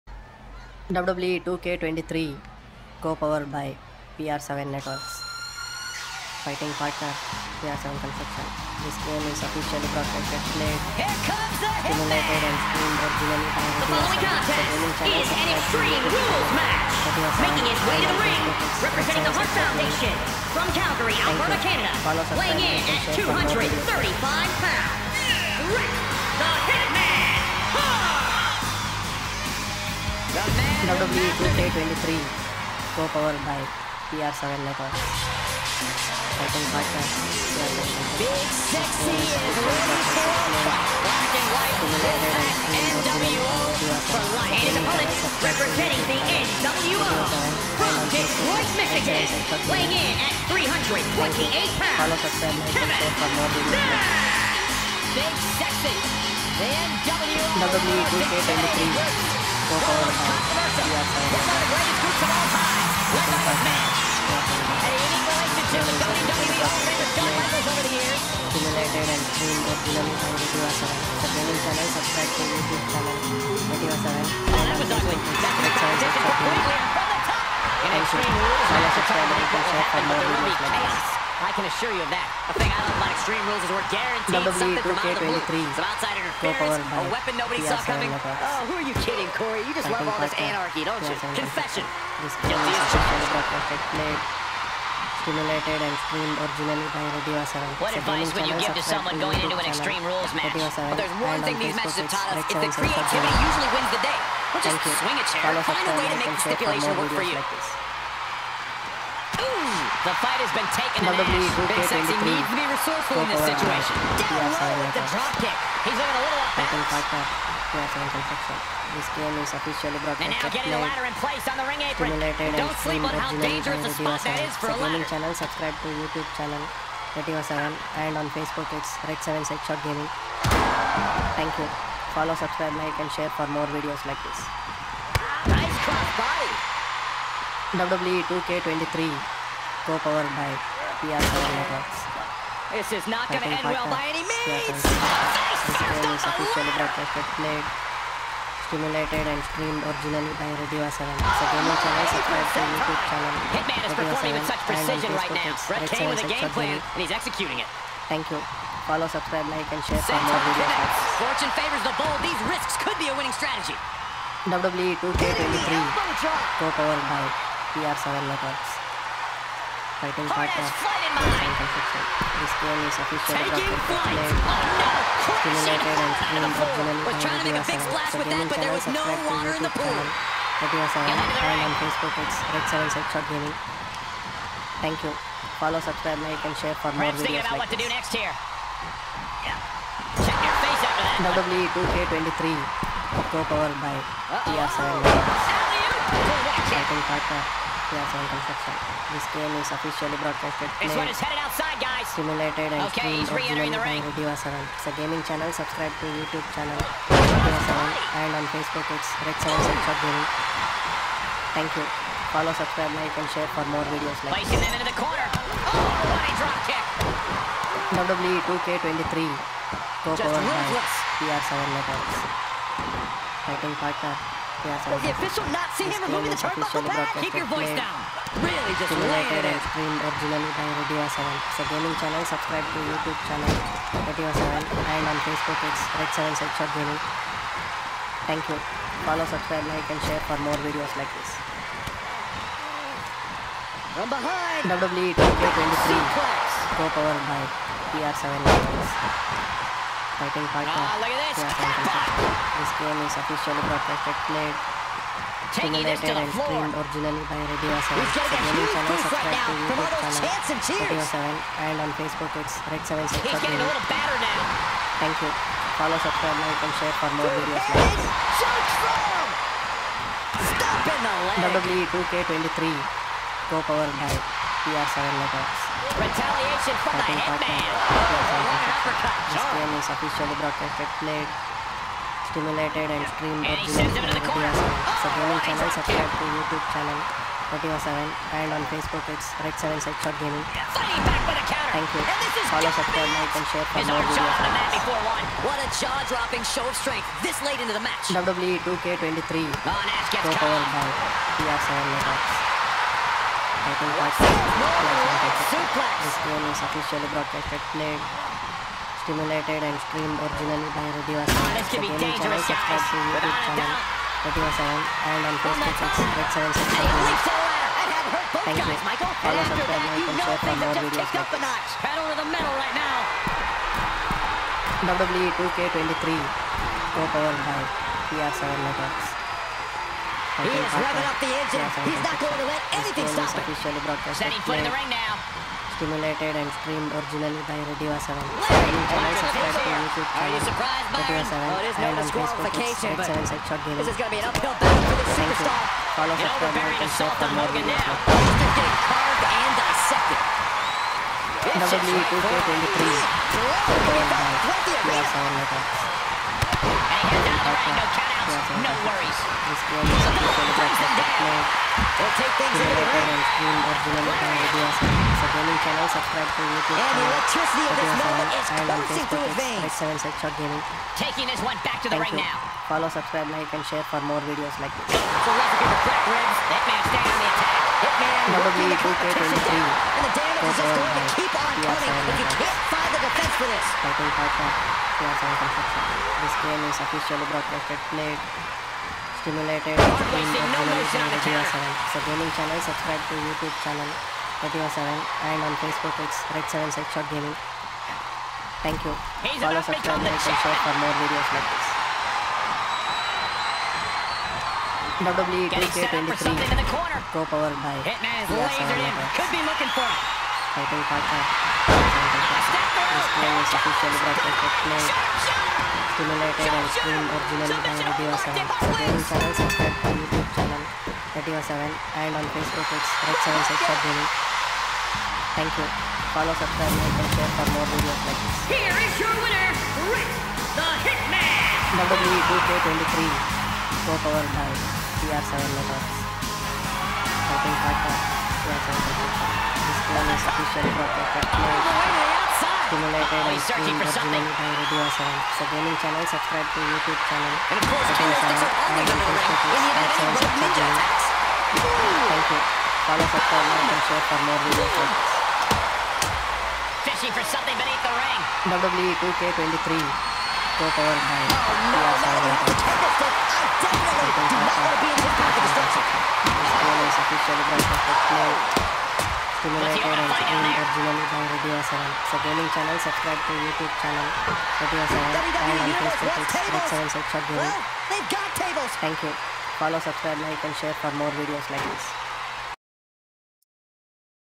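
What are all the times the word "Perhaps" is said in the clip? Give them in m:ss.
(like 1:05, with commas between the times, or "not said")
3:07.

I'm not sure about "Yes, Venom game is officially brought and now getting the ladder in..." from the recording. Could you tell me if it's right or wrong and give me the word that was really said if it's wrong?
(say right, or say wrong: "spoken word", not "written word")
wrong: "This", not "Venom".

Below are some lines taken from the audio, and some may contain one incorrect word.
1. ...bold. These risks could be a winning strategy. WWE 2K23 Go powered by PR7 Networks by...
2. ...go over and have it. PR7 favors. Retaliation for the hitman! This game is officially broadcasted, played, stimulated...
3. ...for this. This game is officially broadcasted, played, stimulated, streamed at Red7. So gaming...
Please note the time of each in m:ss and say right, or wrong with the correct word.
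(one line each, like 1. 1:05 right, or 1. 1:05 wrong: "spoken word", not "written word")
1. 2:41 right
2. 4:33 wrong: "letters", not "favors"
3. 6:23 right.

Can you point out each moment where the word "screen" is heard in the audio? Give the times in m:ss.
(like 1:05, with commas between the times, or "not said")
7:23, 7:50.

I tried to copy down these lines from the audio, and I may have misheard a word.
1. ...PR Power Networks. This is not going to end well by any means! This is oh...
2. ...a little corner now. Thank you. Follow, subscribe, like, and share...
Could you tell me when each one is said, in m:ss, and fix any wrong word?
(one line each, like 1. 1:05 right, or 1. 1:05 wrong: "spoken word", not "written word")
1. 2:21 right
2. 4:23 wrong: "batter", not "corner".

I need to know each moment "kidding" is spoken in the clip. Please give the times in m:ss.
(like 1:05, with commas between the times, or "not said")
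1:29.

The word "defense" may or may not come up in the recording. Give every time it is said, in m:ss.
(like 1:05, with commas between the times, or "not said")
6:23.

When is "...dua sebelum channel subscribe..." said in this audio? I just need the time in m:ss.
7:24.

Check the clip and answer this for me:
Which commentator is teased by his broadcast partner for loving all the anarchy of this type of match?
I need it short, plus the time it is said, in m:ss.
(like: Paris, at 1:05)
Corey, at 1:29.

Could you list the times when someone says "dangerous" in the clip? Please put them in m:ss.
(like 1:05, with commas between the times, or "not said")
2:03, 5:12.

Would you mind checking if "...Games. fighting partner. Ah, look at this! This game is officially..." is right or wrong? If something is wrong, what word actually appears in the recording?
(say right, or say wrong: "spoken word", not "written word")
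right.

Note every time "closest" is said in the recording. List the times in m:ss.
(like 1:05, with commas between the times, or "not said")
not said.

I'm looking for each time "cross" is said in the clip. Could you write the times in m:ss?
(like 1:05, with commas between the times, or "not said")
2:15.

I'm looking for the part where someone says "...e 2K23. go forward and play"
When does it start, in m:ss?
7:38.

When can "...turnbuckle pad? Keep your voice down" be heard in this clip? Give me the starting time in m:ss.
3:46.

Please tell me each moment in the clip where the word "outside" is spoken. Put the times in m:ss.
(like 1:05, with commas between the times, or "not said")
1:25, 3:21.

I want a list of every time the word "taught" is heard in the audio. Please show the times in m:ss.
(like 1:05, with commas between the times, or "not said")
1:42.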